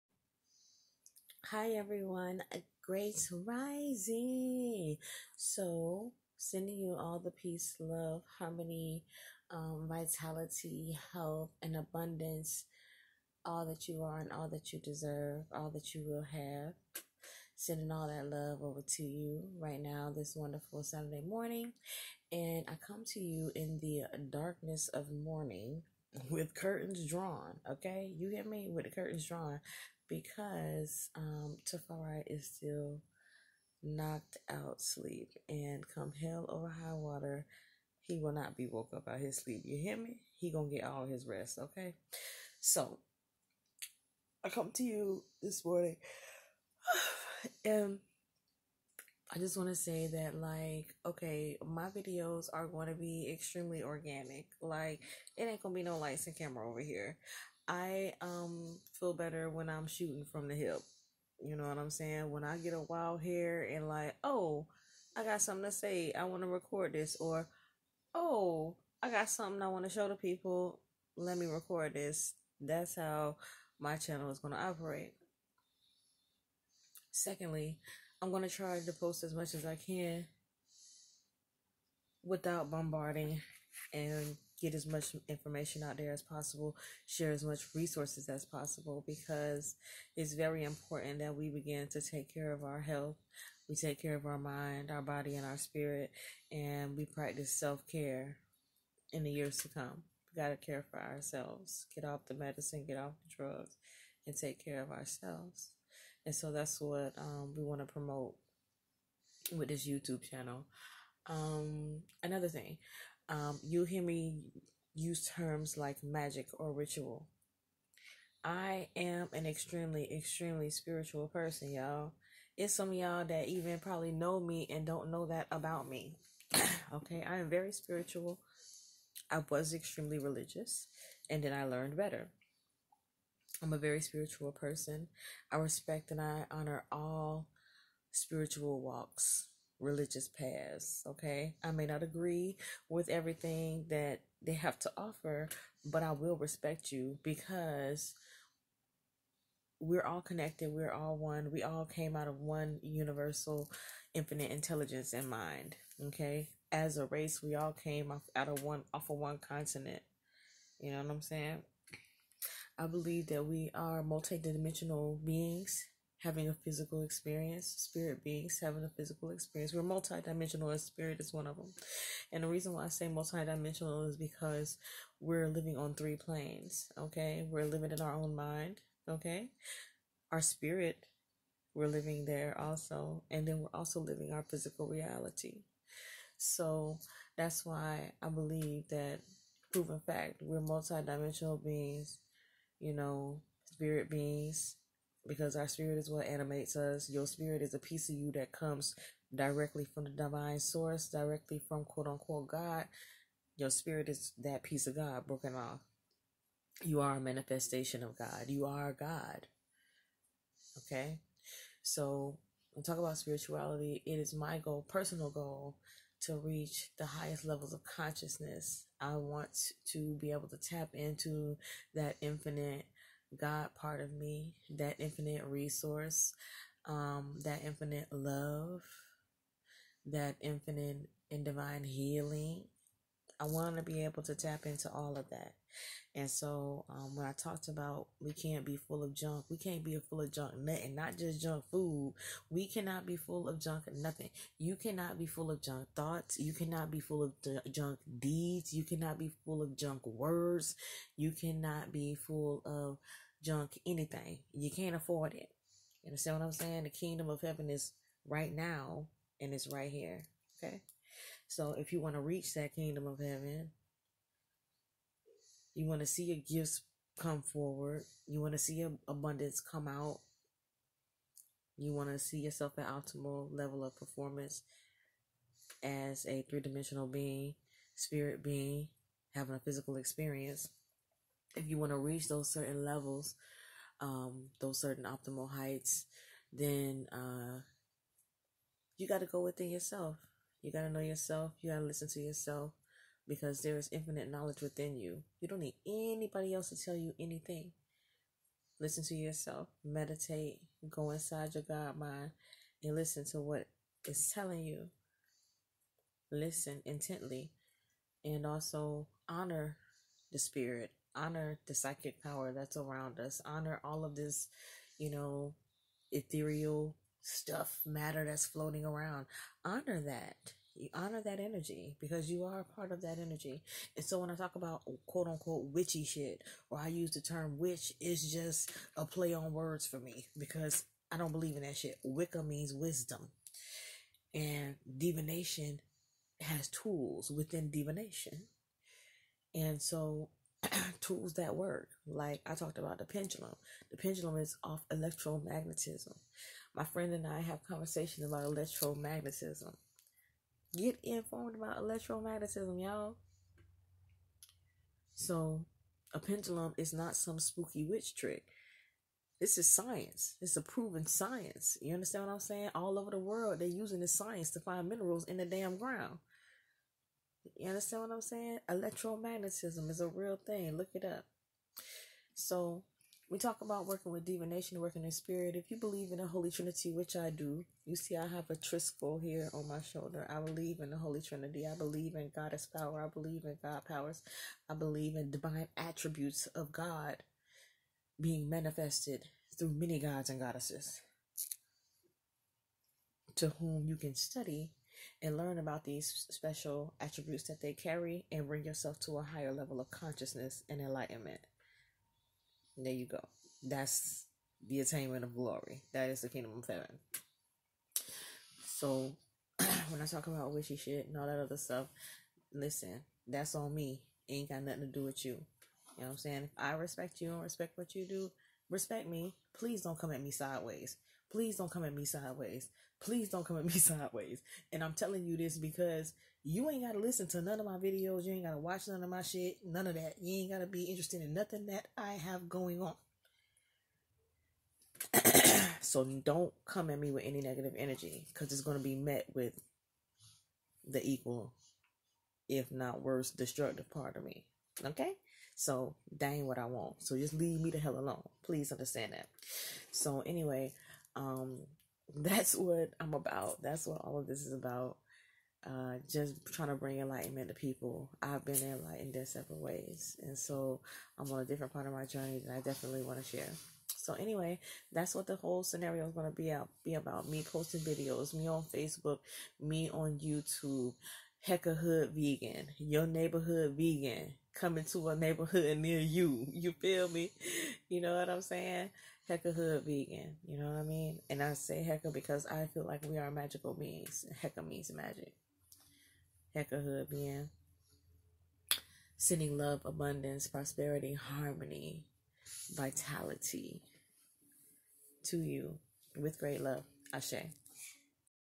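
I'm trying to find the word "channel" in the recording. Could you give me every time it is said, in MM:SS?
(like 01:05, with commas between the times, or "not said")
01:13, 01:50.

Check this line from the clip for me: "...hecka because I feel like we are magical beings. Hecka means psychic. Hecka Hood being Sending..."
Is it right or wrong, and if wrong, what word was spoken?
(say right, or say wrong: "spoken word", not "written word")
wrong: "magic", not "psychic".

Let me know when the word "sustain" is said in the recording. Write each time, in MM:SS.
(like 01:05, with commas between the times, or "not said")
not said.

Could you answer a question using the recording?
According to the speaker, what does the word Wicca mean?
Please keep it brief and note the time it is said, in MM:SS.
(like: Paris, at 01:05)
wisdom, at 05:32.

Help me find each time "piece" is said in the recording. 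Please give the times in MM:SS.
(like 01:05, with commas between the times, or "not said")
03:17, 03:24.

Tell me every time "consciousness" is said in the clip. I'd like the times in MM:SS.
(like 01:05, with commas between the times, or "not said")
03:37, 06:39.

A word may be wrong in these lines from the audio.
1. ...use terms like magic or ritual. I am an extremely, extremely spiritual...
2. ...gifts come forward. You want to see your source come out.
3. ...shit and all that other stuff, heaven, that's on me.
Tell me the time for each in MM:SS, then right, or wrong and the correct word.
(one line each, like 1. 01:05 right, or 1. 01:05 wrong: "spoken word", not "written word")
1. 01:54 right
2. 04:26 wrong: "abundance", not "source"
3. 06:50 wrong: "listen", not "heaven".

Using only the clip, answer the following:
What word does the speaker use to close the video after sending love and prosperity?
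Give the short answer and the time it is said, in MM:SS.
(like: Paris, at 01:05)
Ashe, at 08:17.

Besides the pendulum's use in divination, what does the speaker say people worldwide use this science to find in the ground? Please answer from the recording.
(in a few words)
minerals.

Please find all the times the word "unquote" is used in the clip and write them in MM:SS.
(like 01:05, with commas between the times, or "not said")
03:22, 05:25.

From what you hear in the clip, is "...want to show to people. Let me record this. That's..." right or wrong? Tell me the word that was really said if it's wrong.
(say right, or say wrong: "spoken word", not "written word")
right.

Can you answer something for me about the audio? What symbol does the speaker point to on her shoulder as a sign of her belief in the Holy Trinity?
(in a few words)
triskel.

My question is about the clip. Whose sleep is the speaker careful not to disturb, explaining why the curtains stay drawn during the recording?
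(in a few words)
Tafari.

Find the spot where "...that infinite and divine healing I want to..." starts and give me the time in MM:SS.
03:50.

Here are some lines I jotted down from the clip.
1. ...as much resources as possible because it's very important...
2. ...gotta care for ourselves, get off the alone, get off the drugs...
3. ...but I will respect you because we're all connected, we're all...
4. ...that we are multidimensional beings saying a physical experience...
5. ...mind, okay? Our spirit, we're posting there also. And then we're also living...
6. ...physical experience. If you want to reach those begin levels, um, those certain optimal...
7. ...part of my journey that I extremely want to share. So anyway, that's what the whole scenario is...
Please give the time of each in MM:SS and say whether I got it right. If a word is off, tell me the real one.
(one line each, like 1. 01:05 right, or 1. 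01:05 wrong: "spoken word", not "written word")
1. 01:27 right
2. 01:40 wrong: "medicine", not "alone"
3. 02:25 right
4. 02:43 wrong: "having", not "saying"
5. 02:58 wrong: "living", not "posting"
6. 04:39 wrong: "certain", not "begin"
7. 07:41 wrong: "definitely", not "extremely".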